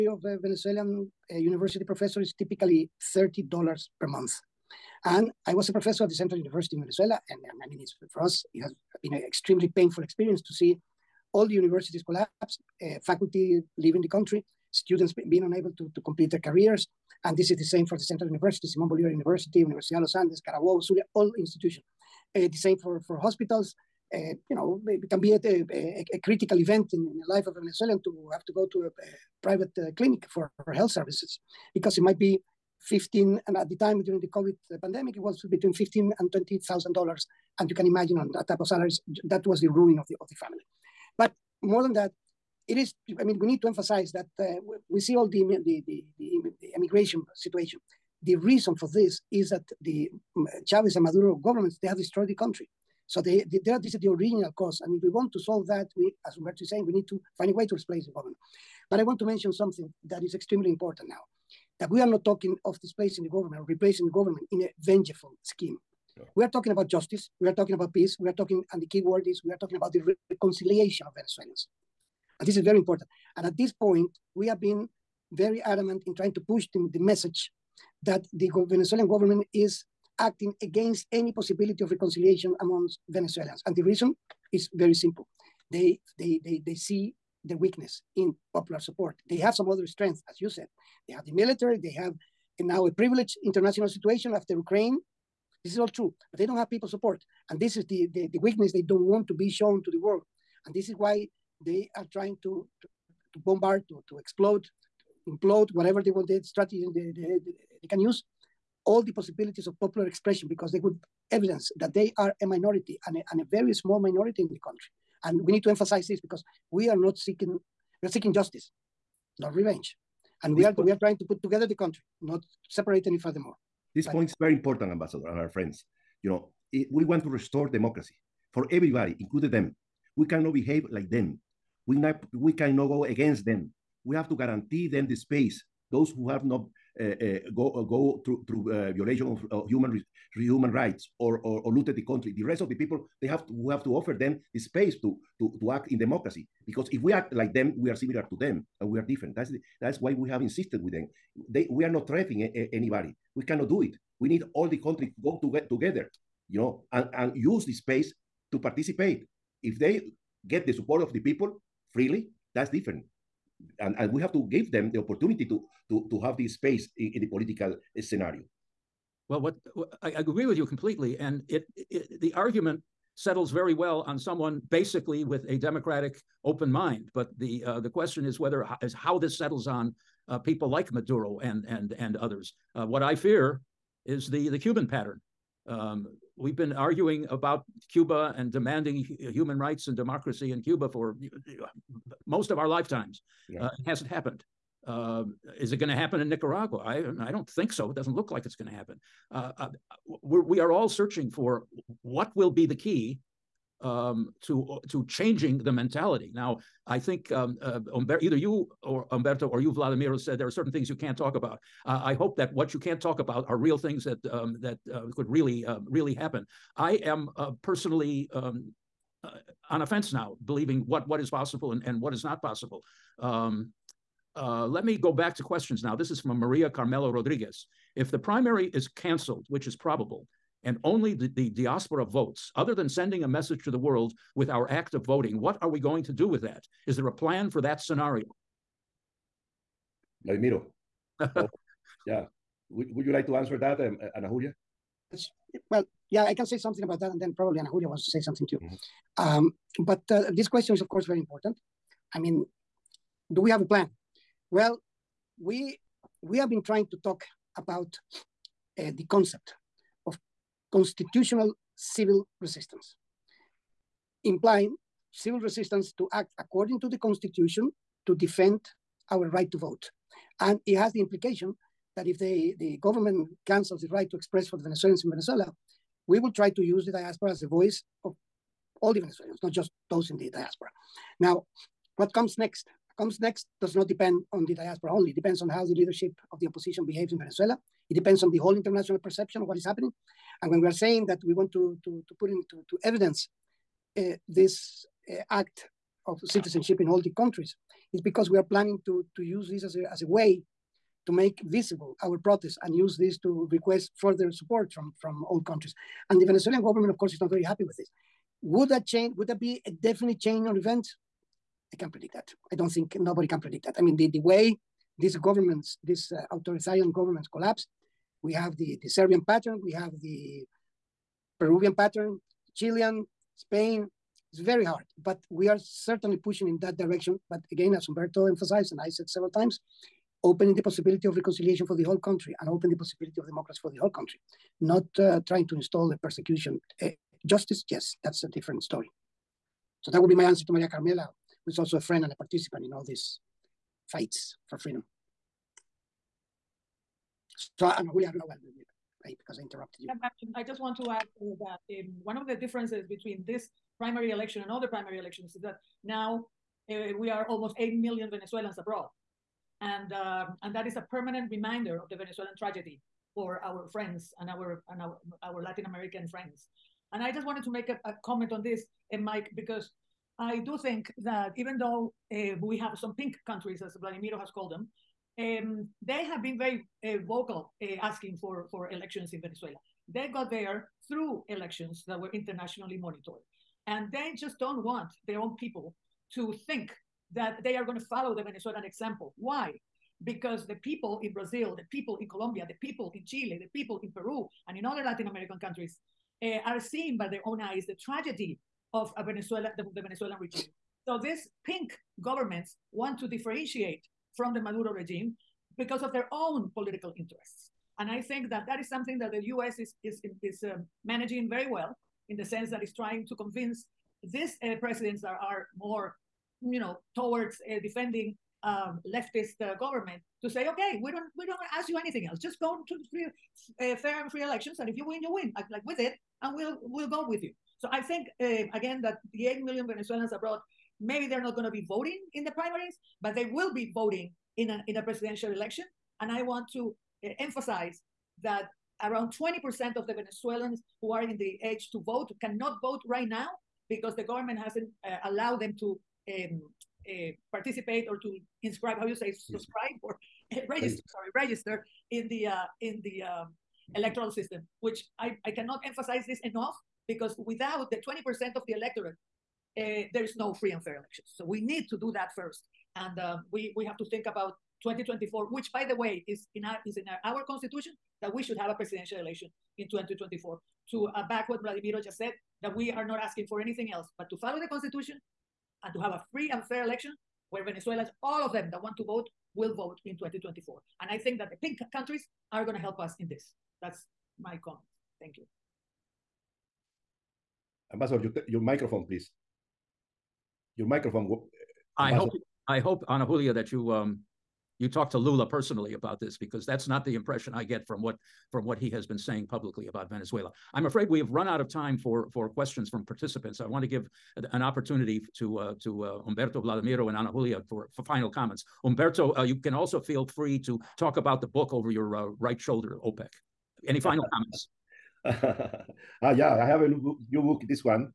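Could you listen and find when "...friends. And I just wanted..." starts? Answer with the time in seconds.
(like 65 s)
366 s.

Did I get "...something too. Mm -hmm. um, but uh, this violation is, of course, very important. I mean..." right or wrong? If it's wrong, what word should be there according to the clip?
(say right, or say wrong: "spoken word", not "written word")
wrong: "question", not "violation".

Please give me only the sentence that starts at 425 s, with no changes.
Like, like with it, and we'll we'll go with you.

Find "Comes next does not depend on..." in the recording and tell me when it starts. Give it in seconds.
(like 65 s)
282 s.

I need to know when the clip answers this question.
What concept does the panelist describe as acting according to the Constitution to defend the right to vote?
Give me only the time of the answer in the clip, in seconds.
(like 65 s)
260 s.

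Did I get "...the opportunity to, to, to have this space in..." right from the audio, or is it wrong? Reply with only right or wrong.
right.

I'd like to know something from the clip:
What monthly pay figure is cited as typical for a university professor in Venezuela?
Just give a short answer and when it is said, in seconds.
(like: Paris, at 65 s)
$30, at 3 s.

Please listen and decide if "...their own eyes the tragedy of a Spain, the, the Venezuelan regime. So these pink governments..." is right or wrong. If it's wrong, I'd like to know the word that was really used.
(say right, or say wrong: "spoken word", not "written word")
wrong: "Venezuela", not "Spain".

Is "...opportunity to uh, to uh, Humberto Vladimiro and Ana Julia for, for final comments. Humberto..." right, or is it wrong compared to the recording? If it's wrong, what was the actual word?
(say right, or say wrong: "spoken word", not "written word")
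right.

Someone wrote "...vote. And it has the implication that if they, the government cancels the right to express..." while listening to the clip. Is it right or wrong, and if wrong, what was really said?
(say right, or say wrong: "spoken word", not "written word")
right.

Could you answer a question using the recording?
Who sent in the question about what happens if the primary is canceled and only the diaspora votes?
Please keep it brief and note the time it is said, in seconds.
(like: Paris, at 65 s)
Maria Carmelo Rodriguez, at 226 s.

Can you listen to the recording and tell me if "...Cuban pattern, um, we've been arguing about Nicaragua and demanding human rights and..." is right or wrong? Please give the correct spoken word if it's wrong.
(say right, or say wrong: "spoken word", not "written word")
wrong: "Cuba", not "Nicaragua".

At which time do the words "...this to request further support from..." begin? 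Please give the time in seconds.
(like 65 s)
302 s.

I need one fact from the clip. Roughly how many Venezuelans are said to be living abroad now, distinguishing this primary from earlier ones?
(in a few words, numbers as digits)
8 million.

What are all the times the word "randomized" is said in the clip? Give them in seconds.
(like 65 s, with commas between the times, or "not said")
not said.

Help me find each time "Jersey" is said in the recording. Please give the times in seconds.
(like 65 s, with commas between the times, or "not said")
not said.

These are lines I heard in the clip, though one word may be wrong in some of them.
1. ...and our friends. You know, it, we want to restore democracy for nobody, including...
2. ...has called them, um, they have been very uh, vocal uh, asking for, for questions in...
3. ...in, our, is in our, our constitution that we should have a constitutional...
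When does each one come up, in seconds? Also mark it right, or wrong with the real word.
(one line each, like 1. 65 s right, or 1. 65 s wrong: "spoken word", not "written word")
1. 125 s wrong: "everybody", not "nobody"
2. 374 s wrong: "elections", not "questions"
3. 466 s wrong: "presidential", not "constitutional".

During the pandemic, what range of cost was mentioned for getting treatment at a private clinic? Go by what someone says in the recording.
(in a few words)
15,000 to 20,000 dollars.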